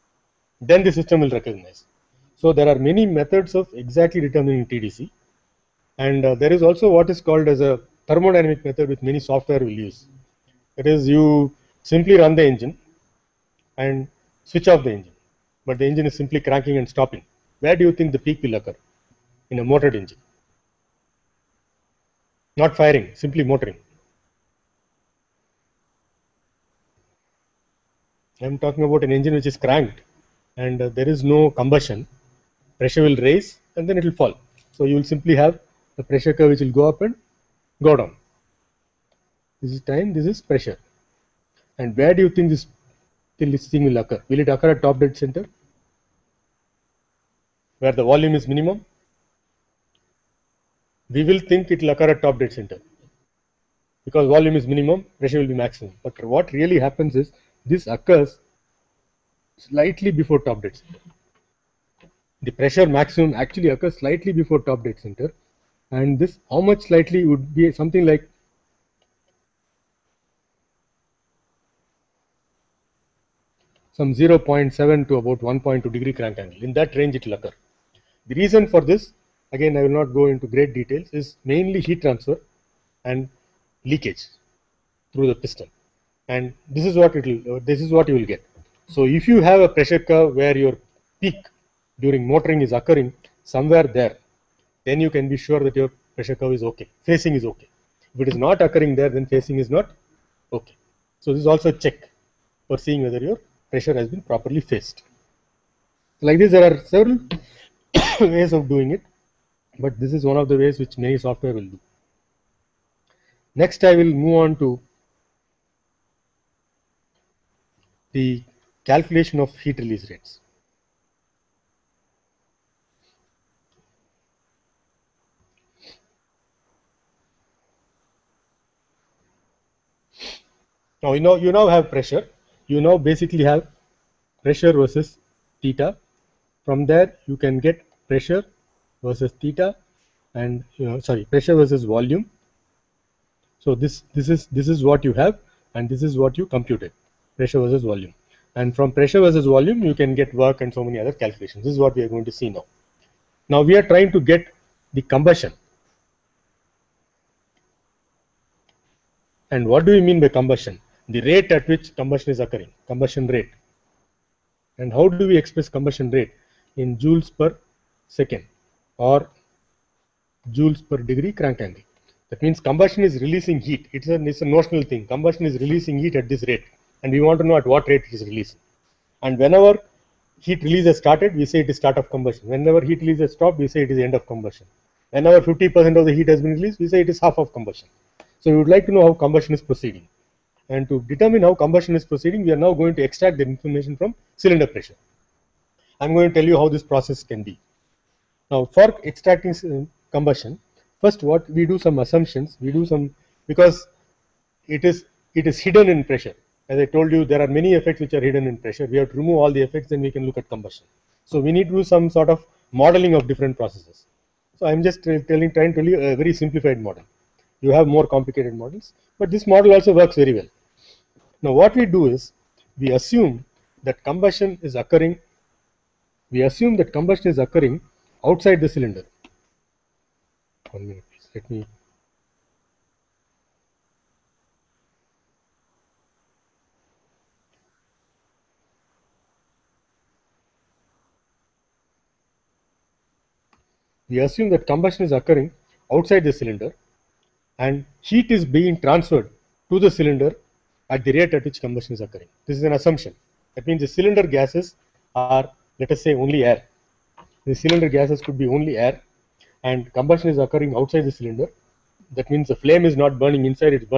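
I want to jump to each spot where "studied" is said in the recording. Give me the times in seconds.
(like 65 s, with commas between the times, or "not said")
not said.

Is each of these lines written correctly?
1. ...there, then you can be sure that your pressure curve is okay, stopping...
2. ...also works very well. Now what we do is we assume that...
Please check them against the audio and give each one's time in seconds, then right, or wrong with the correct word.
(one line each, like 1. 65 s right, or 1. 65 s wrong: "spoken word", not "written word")
1. 93 s wrong: "phasing", not "stopping"
2. 219 s right.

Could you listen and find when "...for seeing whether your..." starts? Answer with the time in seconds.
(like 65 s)
102 s.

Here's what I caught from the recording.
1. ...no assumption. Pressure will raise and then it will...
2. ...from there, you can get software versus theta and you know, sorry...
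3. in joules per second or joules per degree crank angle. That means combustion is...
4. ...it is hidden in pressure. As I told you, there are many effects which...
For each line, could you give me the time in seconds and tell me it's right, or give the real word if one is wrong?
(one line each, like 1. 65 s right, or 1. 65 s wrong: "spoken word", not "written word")
1. 31 s wrong: "combustion", not "assumption"
2. 136 s wrong: "pressure", not "software"
3. 166 s right
4. 205 s right.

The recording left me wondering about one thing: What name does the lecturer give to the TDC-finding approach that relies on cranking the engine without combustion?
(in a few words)
Thermodynamic method.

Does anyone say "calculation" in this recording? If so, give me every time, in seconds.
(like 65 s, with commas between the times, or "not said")
118 s, 151 s.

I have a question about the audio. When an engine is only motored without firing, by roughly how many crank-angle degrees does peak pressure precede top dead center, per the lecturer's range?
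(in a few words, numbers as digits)
0.7 to 1.2 degrees.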